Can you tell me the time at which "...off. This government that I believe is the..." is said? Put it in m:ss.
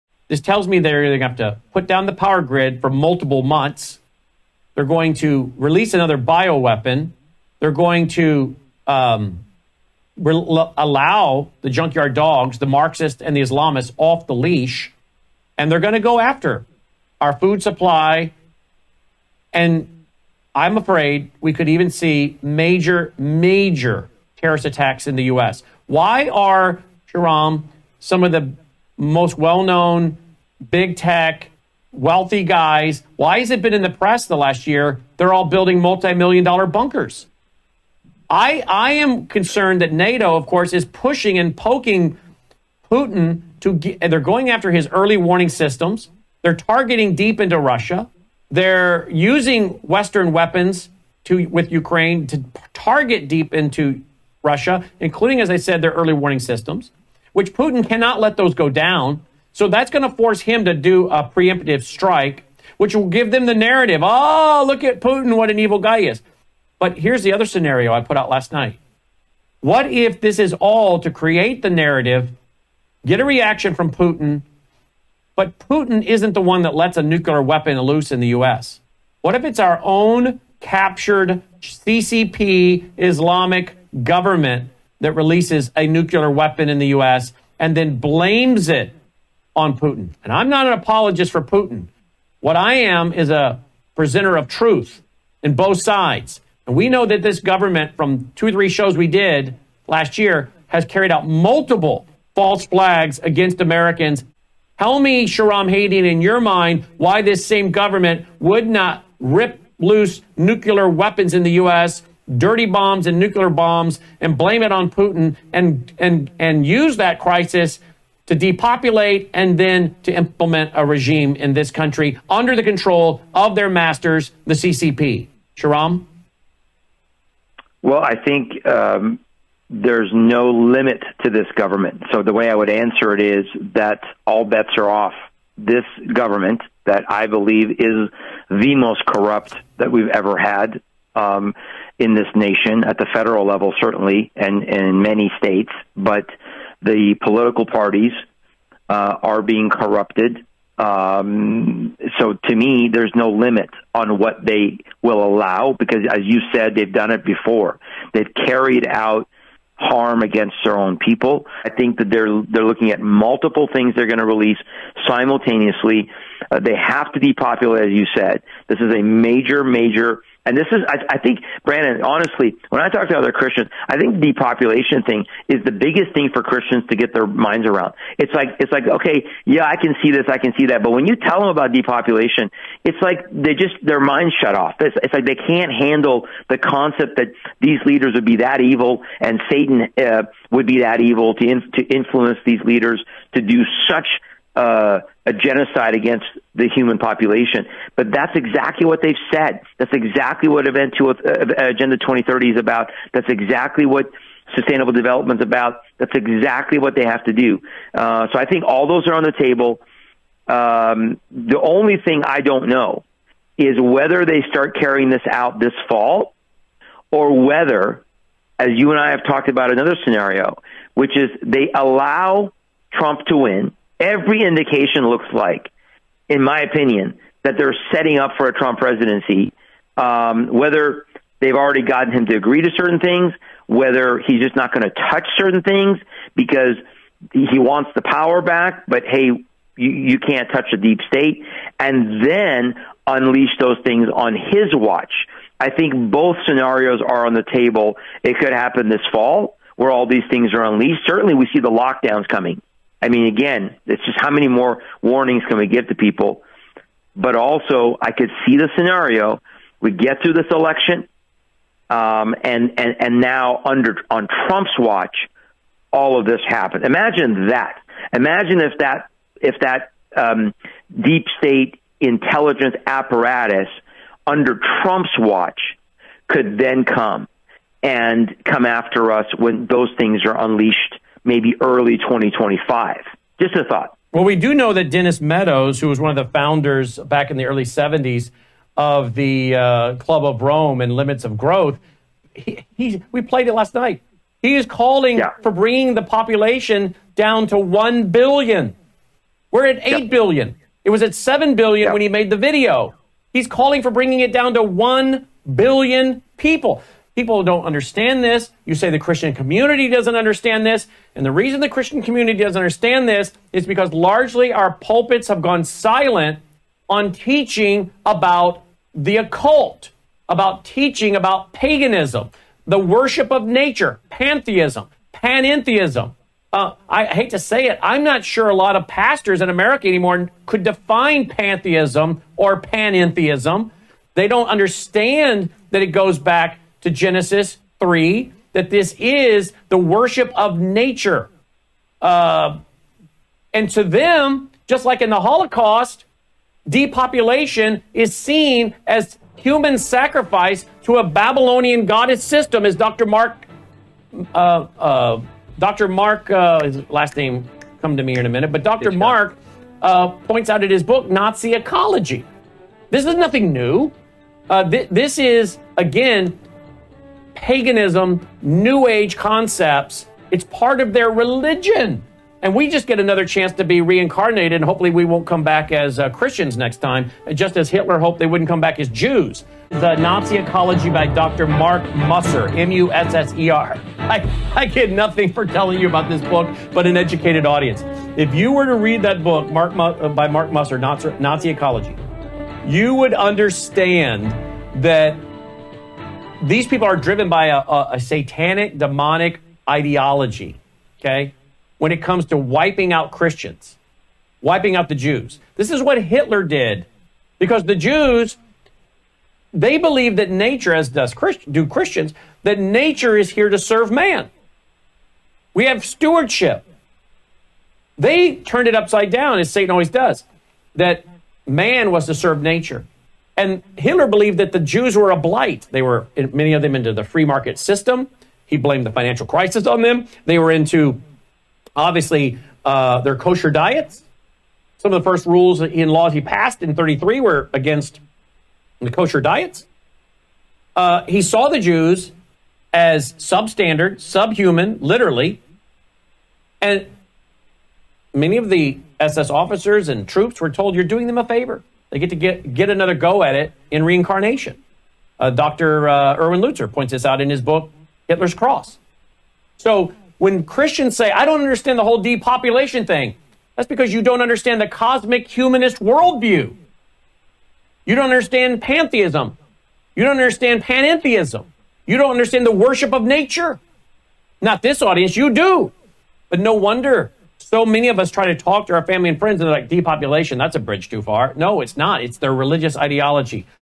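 2:14.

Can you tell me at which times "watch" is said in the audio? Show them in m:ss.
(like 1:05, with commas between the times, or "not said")
4:04, 4:24, 4:35.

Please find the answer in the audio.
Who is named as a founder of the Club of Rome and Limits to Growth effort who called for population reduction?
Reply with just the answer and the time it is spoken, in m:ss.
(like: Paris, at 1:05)
Dennis Meadows, at 4:44.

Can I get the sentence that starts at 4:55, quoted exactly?
for bringing the population down to 1 billion.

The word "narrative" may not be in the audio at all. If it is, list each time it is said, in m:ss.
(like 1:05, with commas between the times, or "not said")
1:03, 1:11.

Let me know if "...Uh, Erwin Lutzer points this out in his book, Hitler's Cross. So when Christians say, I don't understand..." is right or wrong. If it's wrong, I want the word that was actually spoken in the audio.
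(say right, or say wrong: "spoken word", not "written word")
right.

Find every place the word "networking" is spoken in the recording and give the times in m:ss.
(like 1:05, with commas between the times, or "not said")
not said.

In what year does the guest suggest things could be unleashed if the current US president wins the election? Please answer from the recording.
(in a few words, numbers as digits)
2025.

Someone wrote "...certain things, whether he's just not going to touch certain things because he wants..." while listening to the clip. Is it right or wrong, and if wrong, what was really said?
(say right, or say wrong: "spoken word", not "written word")
right.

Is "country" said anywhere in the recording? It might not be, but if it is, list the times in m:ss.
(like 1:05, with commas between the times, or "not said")
2:01.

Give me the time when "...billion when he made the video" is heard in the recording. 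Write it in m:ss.
5:01.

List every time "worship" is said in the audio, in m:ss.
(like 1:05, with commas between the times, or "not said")
5:22, 5:39, 7:52.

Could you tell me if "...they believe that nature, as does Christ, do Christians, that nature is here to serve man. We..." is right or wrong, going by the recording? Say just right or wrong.
right.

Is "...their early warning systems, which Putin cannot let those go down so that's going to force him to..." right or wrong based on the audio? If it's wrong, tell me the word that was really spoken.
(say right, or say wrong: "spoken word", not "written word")
right.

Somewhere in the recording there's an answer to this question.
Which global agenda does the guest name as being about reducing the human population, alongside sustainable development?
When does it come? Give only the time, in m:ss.
3:21.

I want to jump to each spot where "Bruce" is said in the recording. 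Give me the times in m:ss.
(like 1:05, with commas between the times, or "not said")
not said.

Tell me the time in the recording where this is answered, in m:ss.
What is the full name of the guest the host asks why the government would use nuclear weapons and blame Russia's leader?
1:45.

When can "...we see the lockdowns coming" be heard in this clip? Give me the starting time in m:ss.
4:11.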